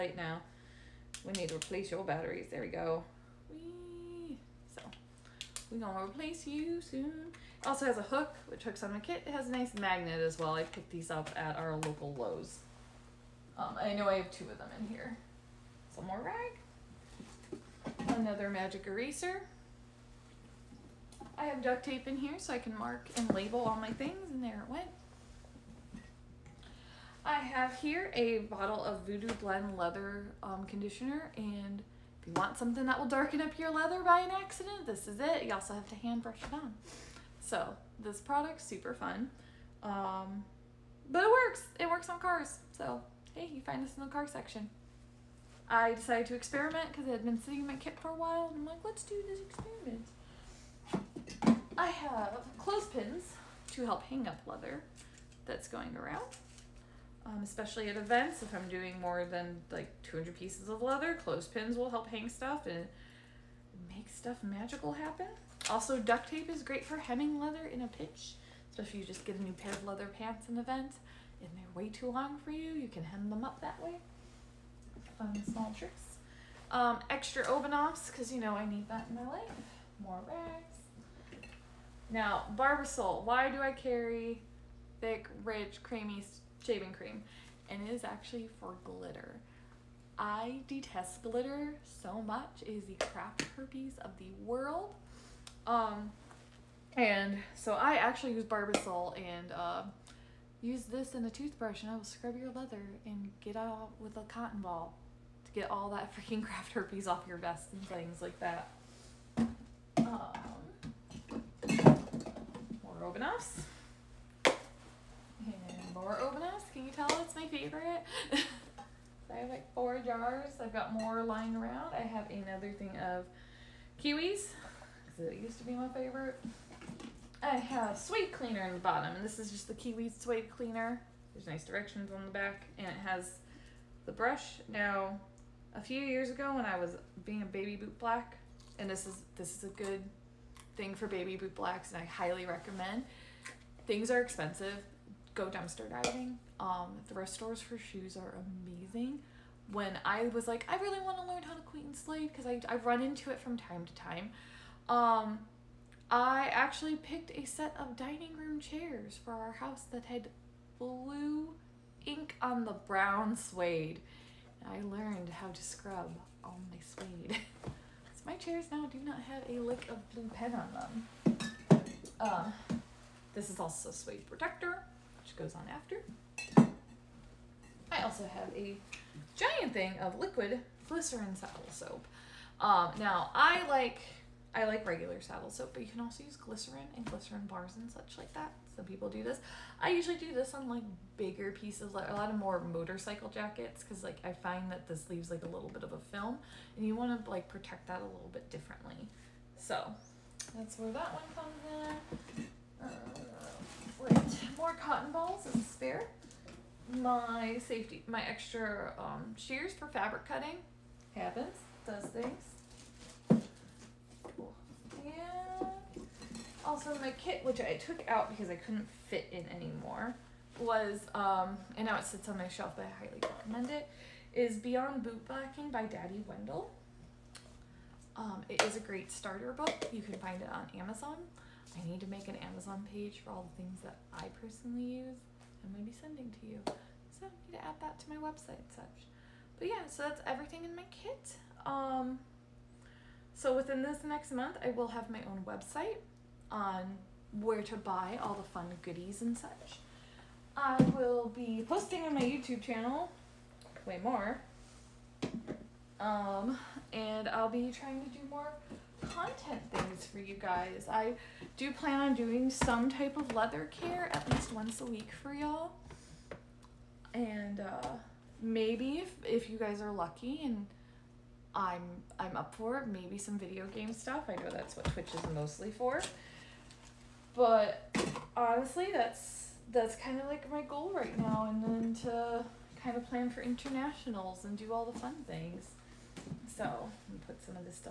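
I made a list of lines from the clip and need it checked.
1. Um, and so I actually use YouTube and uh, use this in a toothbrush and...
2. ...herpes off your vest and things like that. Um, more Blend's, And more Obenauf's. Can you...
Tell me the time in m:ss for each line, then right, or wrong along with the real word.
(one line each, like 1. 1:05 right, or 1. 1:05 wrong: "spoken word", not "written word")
1. 1:35 wrong: "Barbasol", not "YouTube"
2. 1:46 wrong: "Obenauf", not "Blend".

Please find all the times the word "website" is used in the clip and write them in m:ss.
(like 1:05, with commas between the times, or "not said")
3:58, 4:05.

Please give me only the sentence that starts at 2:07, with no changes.
I have suede cleaner in the bottom, and this is just the kiwi suede cleaner.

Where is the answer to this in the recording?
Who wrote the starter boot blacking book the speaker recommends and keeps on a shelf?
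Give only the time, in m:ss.
3:45.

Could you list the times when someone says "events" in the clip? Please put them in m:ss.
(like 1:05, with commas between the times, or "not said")
0:57, 1:10.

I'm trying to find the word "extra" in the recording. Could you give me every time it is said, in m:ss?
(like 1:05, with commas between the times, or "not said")
1:17, 3:28.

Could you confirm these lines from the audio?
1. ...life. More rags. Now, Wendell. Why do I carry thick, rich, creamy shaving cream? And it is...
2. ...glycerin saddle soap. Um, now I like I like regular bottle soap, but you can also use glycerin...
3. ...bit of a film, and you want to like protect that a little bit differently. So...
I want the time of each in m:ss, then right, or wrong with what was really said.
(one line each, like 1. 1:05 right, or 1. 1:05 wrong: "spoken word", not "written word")
1. 1:19 wrong: "Barbasol", not "Wendell"
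2. 3:00 wrong: "saddle", not "bottle"
3. 3:15 right.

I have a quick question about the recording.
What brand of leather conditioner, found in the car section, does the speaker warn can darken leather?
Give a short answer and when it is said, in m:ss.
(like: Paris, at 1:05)
Voodoo Blend, at 0:29.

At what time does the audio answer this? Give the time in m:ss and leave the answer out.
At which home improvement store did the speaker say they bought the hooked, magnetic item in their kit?
0:12.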